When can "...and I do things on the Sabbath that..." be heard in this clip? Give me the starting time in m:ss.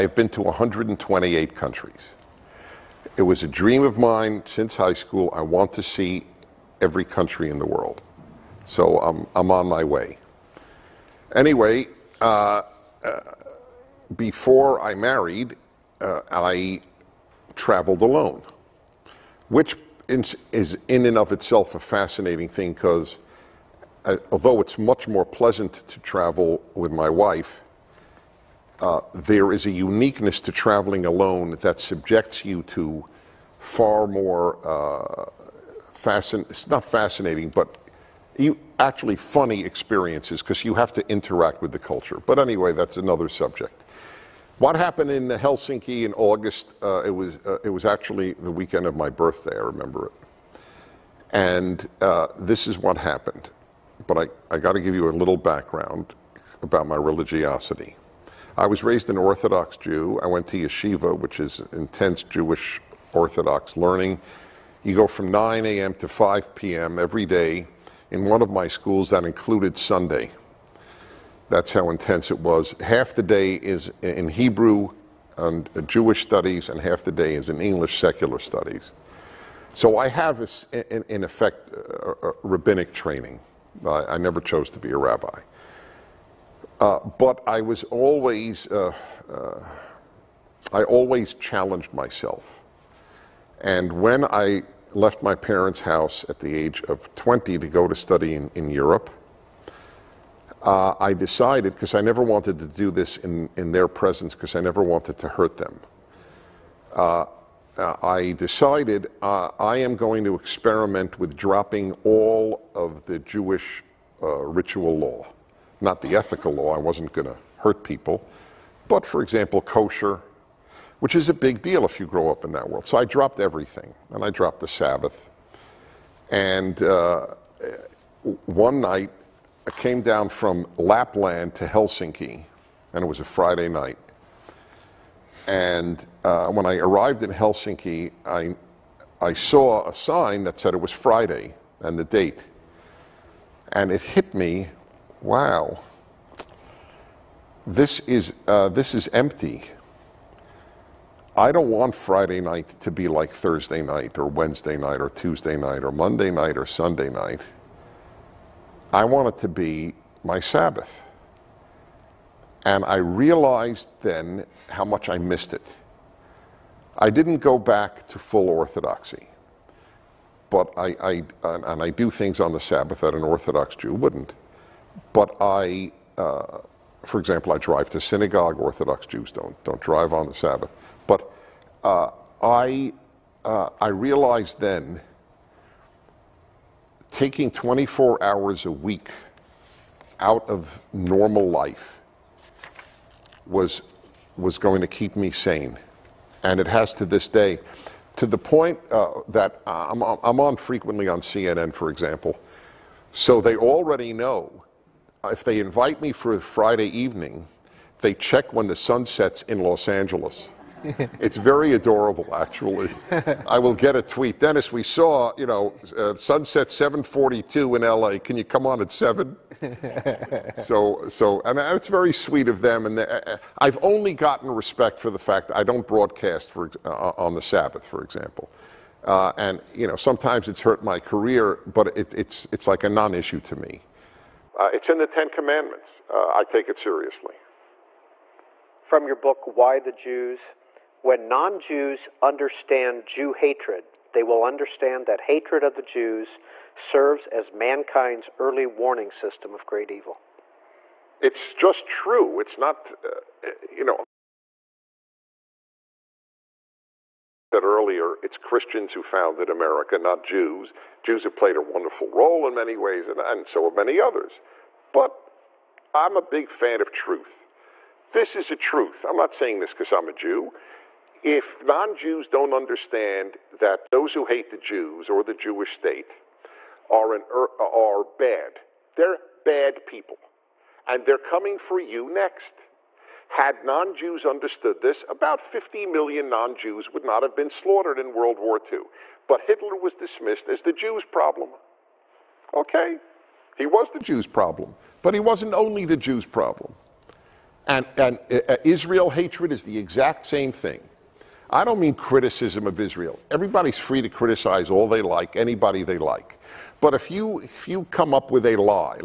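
2:51.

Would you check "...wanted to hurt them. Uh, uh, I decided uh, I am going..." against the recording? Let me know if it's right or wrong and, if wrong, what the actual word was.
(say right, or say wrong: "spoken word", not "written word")
right.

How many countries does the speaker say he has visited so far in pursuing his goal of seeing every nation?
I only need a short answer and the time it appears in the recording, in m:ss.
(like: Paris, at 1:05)
128, at 0:00.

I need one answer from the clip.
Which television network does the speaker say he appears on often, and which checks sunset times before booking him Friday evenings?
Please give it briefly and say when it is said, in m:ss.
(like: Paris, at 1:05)
CNN, at 3:21.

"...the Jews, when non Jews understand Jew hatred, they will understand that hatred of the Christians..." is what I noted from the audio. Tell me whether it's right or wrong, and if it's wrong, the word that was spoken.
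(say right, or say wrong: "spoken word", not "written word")
wrong: "Jews", not "Christians".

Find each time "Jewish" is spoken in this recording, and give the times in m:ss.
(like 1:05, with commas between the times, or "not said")
1:02, 1:15, 1:53, 4:35.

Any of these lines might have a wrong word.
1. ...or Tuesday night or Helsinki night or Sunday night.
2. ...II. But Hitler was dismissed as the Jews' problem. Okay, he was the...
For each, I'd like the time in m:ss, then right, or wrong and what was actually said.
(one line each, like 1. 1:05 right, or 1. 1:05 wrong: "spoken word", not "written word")
1. 2:34 wrong: "Monday", not "Helsinki"
2. 4:48 right.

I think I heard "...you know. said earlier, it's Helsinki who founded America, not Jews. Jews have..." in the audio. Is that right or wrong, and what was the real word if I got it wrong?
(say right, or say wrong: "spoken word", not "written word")
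wrong: "Christians", not "Helsinki".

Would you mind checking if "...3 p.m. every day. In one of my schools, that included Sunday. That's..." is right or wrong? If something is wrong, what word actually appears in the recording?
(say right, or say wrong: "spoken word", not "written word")
wrong: "5", not "3".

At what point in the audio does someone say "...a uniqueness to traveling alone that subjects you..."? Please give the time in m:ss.
0:29.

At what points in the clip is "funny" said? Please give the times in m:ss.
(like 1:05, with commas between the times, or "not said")
0:39.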